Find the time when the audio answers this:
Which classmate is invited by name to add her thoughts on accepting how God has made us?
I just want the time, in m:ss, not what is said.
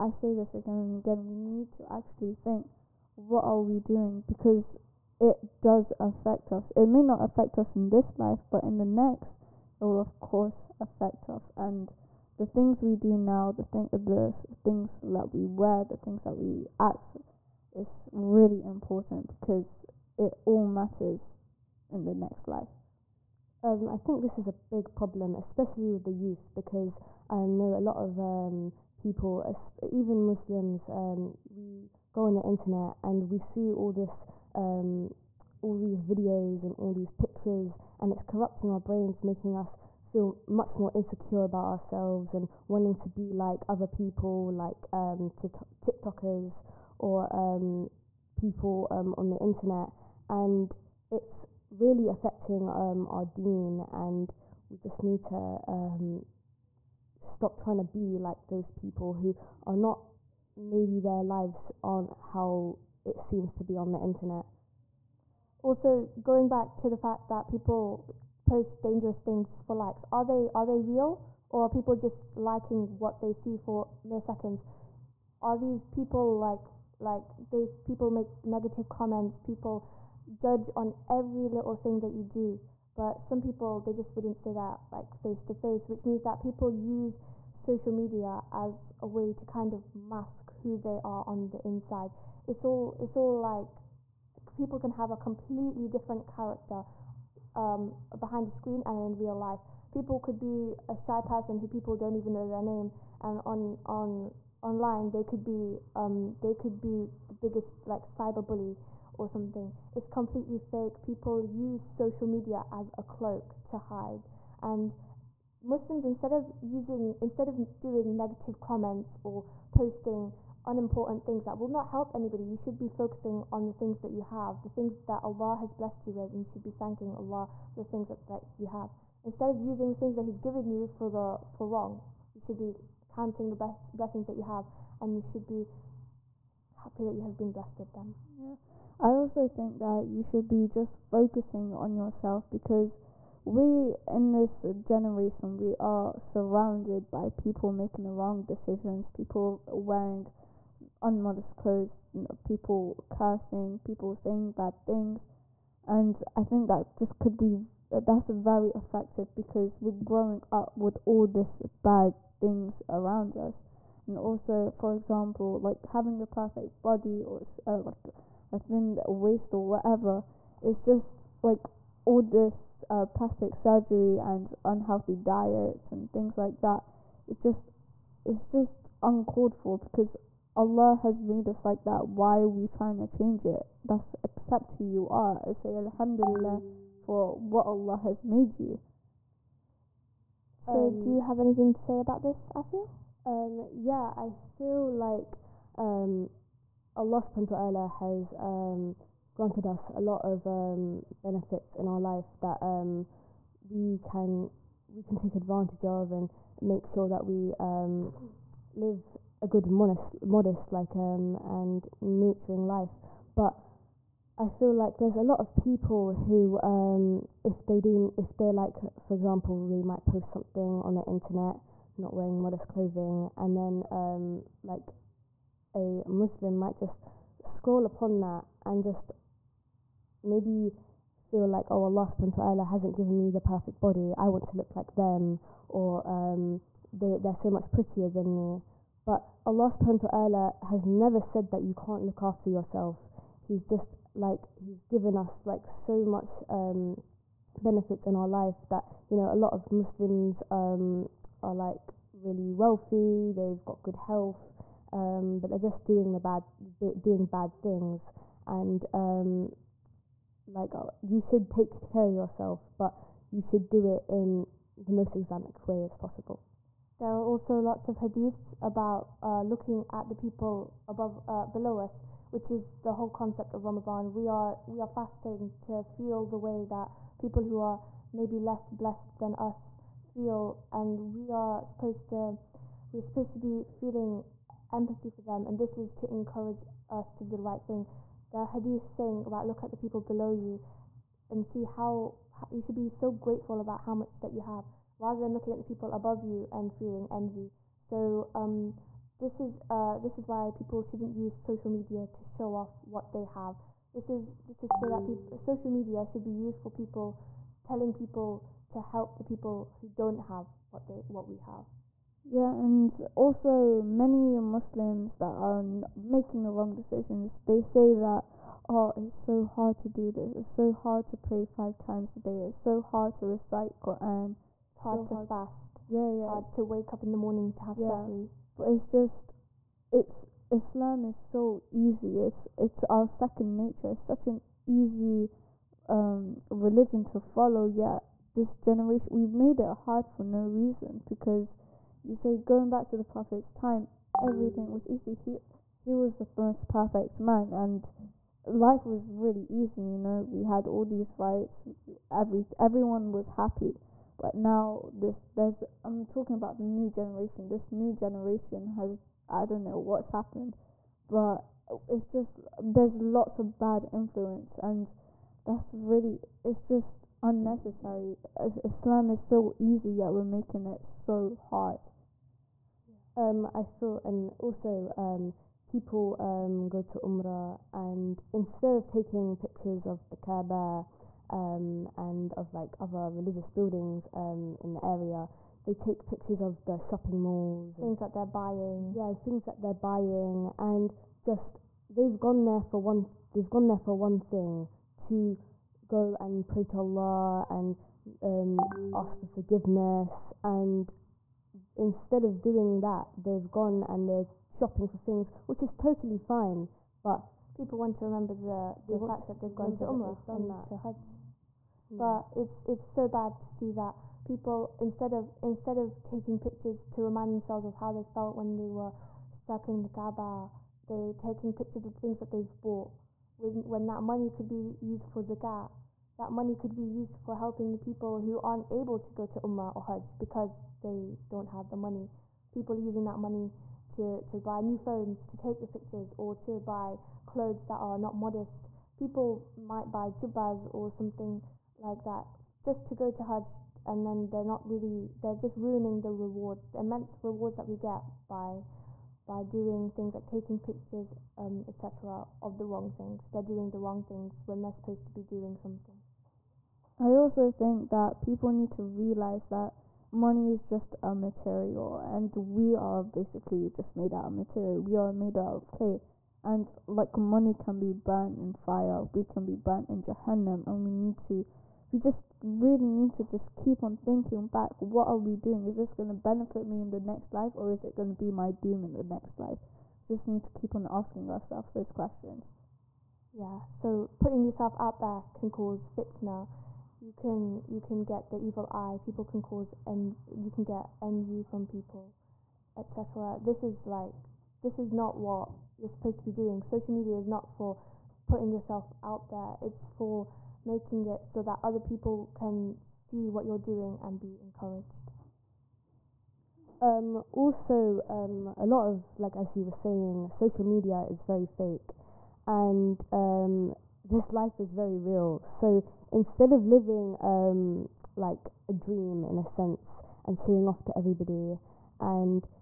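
3:12.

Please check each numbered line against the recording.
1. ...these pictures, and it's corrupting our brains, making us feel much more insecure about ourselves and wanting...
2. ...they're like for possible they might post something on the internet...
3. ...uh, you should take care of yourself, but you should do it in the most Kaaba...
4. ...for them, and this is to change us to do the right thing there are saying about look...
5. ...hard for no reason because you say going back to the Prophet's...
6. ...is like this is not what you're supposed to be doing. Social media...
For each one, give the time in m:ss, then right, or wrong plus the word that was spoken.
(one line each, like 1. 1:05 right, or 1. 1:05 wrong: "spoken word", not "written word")
1. 0:36 right
2. 3:38 wrong: "example", not "possible"
3. 4:20 wrong: "Islamic", not "Kaaba"
4. 4:45 wrong: "encourage", not "change"
5. 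5:39 right
6. 8:13 right.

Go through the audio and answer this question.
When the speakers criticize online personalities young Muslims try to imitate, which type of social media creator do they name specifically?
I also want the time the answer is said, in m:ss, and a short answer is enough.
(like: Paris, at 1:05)
TikTokers, at 0:45.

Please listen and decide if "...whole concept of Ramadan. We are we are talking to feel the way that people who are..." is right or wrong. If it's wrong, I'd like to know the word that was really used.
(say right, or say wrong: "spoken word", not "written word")
wrong: "fasting", not "talking".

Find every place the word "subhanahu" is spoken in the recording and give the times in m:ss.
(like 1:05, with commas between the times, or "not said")
3:17, 3:52, 3:59.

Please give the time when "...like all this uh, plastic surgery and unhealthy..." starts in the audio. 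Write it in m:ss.
2:51.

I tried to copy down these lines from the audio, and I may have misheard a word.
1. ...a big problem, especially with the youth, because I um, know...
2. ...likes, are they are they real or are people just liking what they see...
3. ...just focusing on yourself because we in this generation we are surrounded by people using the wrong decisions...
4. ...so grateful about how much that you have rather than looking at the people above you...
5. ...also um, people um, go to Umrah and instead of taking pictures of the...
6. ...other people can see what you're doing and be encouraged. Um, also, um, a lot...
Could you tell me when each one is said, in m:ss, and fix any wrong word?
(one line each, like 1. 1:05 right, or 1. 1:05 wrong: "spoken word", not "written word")
1. 0:24 right
2. 1:09 right
3. 2:20 wrong: "making", not "using"
4. 4:52 right
5. 6:14 right
6. 8:21 right.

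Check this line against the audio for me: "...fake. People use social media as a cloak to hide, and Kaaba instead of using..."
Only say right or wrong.
wrong.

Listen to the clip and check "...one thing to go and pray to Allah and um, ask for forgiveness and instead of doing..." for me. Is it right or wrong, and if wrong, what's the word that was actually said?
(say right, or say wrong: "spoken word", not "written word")
right.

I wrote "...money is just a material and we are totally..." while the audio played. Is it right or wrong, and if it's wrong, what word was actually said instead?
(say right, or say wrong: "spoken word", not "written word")
wrong: "basically", not "totally".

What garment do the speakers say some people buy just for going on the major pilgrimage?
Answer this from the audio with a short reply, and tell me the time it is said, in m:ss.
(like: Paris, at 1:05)
jubbas, at 7:20.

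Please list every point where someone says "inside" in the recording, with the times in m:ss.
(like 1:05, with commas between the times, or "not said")
1:31.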